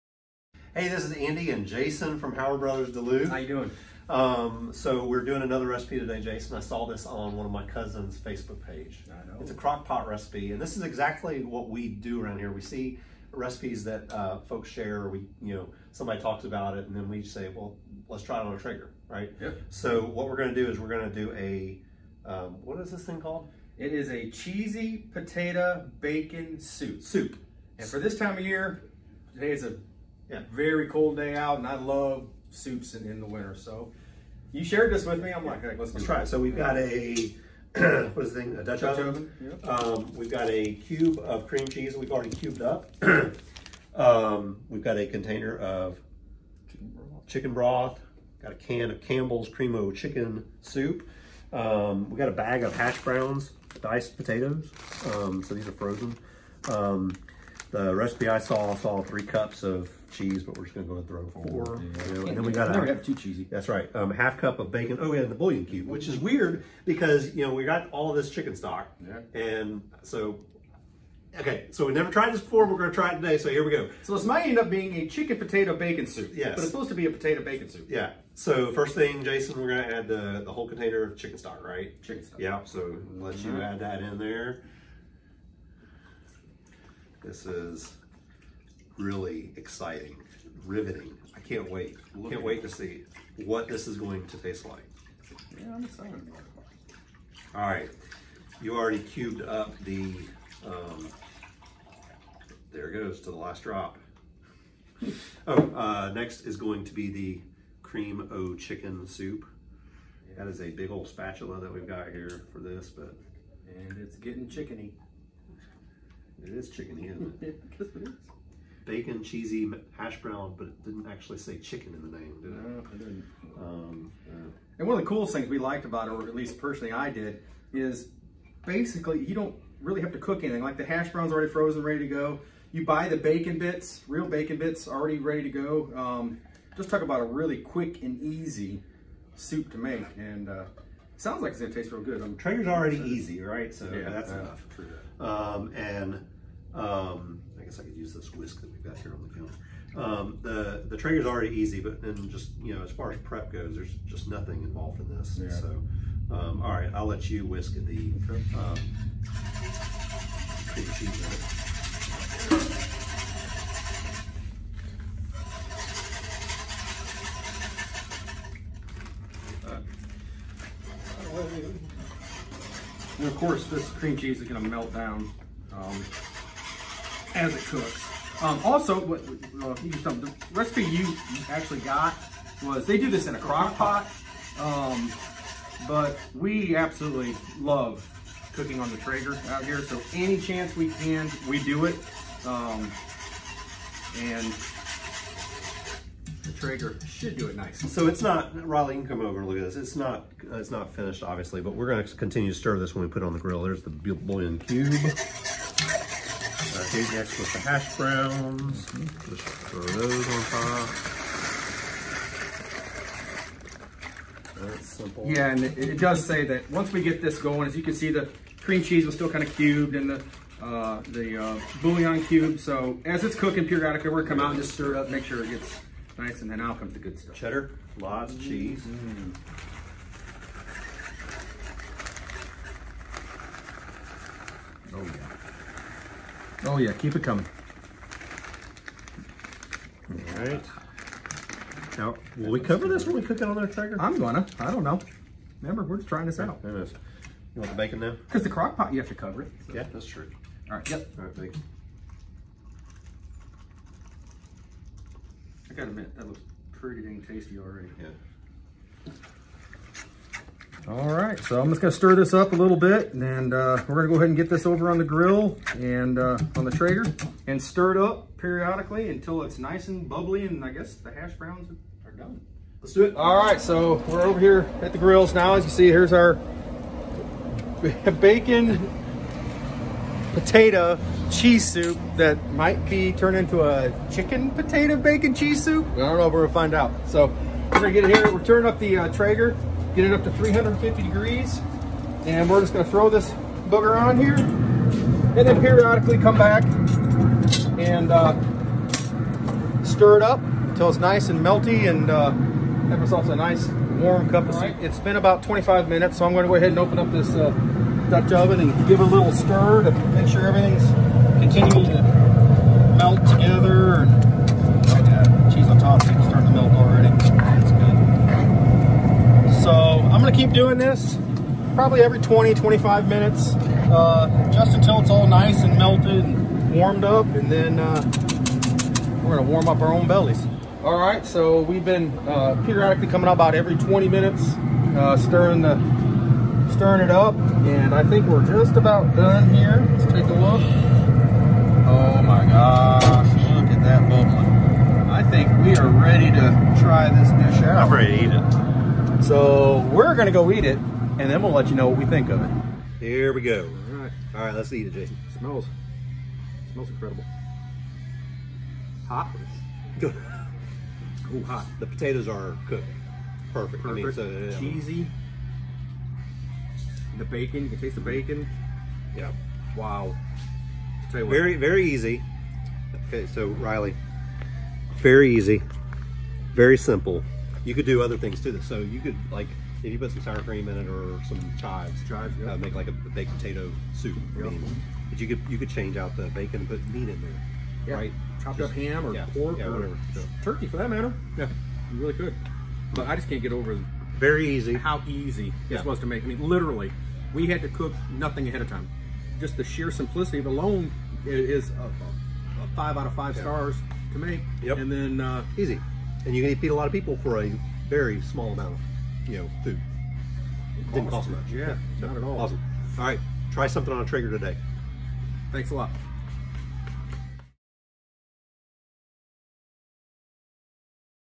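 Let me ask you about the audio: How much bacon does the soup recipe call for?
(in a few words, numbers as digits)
half cup.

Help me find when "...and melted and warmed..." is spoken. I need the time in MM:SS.
05:25.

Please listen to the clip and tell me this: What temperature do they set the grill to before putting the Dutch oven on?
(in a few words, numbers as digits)
350 degrees.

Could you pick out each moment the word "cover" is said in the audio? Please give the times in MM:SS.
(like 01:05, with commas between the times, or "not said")
04:02, 04:09.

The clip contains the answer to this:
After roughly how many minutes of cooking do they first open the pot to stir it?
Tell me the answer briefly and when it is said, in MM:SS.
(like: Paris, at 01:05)
25 minutes, at 05:05.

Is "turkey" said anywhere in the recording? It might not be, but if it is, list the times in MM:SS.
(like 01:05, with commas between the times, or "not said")
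06:30.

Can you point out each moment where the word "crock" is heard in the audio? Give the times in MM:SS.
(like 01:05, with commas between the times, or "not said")
00:09, 03:03, 04:08.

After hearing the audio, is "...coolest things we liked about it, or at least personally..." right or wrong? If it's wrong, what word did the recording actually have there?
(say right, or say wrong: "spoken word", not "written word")
right.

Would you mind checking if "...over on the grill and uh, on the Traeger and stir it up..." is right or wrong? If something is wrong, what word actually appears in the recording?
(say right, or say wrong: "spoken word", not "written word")
right.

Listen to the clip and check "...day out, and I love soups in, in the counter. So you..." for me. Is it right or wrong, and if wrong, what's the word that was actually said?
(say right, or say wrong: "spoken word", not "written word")
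wrong: "winter", not "counter".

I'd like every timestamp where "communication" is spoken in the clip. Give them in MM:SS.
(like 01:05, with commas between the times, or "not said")
not said.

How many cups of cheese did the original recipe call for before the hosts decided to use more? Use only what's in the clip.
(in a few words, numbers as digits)
3.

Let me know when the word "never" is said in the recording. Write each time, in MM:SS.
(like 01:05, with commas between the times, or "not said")
01:02, 01:11.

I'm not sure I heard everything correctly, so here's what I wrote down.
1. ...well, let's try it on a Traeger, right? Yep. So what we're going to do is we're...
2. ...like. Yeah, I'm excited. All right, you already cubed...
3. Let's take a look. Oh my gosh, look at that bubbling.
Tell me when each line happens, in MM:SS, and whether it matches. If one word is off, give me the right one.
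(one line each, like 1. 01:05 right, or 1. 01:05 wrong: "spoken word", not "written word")
1. 00:17 right
2. 01:34 right
3. 05:39 right.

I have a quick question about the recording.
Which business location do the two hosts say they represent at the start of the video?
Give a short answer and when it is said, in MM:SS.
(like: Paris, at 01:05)
Howard Brothers Duluth, at 00:02.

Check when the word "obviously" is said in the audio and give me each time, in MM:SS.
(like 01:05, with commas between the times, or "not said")
03:21.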